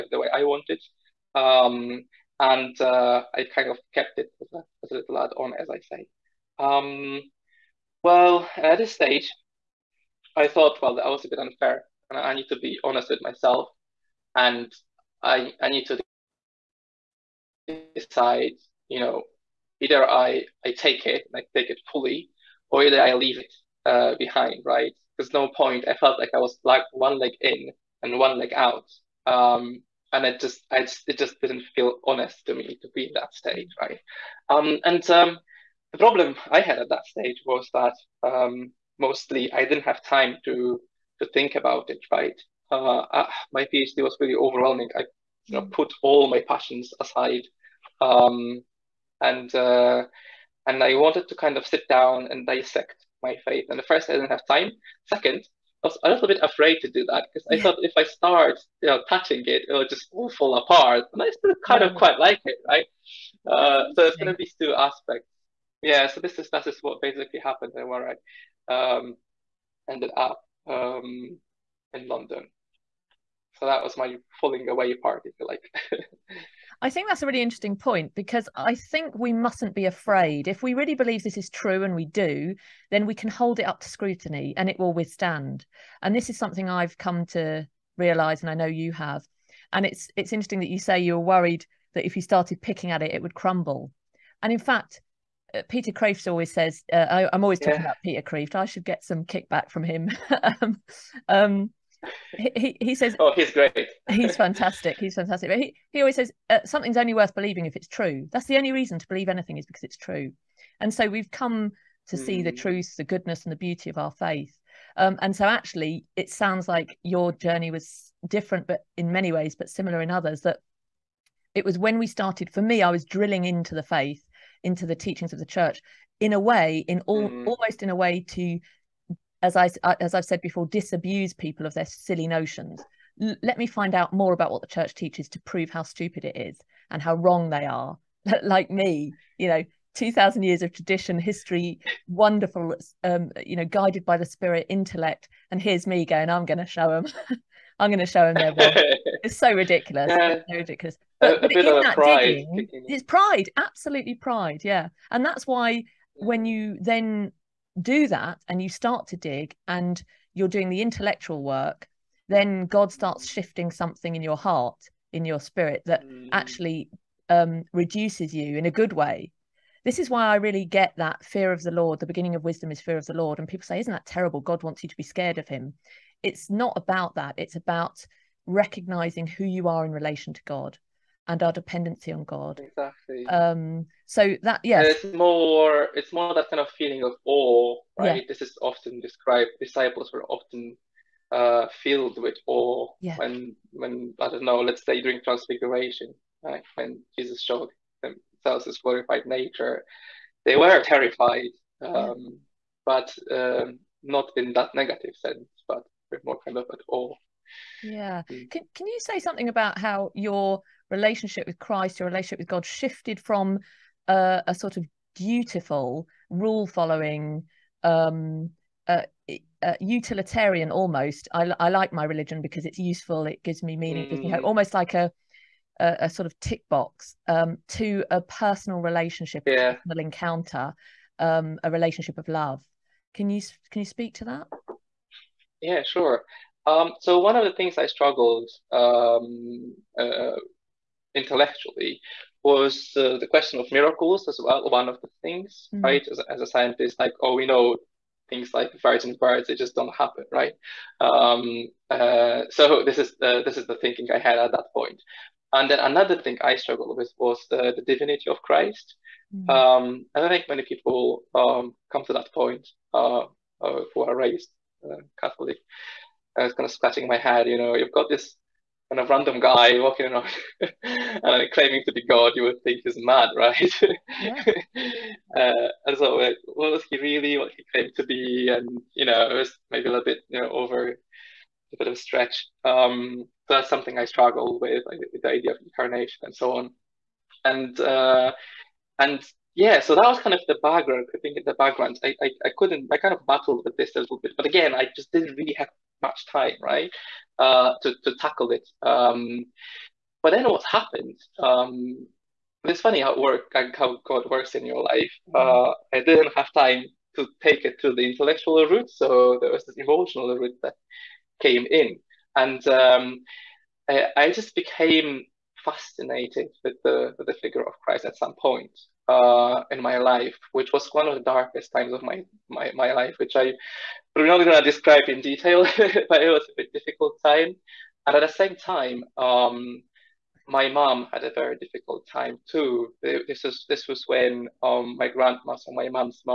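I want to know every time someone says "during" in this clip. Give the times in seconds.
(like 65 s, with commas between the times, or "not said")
195 s.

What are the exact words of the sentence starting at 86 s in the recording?
And this is something I've come to realize and I know you have.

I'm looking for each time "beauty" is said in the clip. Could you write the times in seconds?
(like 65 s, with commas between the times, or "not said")
113 s.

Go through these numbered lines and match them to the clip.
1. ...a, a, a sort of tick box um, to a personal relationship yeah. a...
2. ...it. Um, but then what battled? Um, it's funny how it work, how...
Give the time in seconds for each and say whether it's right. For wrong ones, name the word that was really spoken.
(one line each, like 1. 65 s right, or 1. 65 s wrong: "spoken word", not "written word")
1. 224 s right
2. 298 s wrong: "happened", not "battled".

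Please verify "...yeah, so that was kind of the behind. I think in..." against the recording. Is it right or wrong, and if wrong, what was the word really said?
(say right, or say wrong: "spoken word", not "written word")
wrong: "background", not "behind".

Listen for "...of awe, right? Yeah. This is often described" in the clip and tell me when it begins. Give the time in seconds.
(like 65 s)
187 s.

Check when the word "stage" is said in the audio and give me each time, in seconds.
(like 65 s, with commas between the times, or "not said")
8 s, 37 s.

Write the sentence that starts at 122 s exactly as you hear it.
For me, I was drilling into the faith, into the teachings of the church, in a way, in all, mm.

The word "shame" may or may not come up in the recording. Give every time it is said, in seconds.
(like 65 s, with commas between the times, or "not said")
not said.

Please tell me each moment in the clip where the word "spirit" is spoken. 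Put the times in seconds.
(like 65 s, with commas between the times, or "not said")
144 s, 165 s.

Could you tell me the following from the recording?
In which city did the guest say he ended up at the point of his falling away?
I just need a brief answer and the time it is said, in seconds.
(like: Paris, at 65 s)
London, at 72 s.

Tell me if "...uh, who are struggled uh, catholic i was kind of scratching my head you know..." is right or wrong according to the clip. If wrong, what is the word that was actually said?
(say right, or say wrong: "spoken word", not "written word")
wrong: "raised", not "struggled".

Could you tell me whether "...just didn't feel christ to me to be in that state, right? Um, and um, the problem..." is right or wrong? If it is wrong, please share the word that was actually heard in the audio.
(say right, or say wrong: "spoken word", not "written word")
wrong: "honest", not "christ".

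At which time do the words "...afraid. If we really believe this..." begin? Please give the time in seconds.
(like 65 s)
79 s.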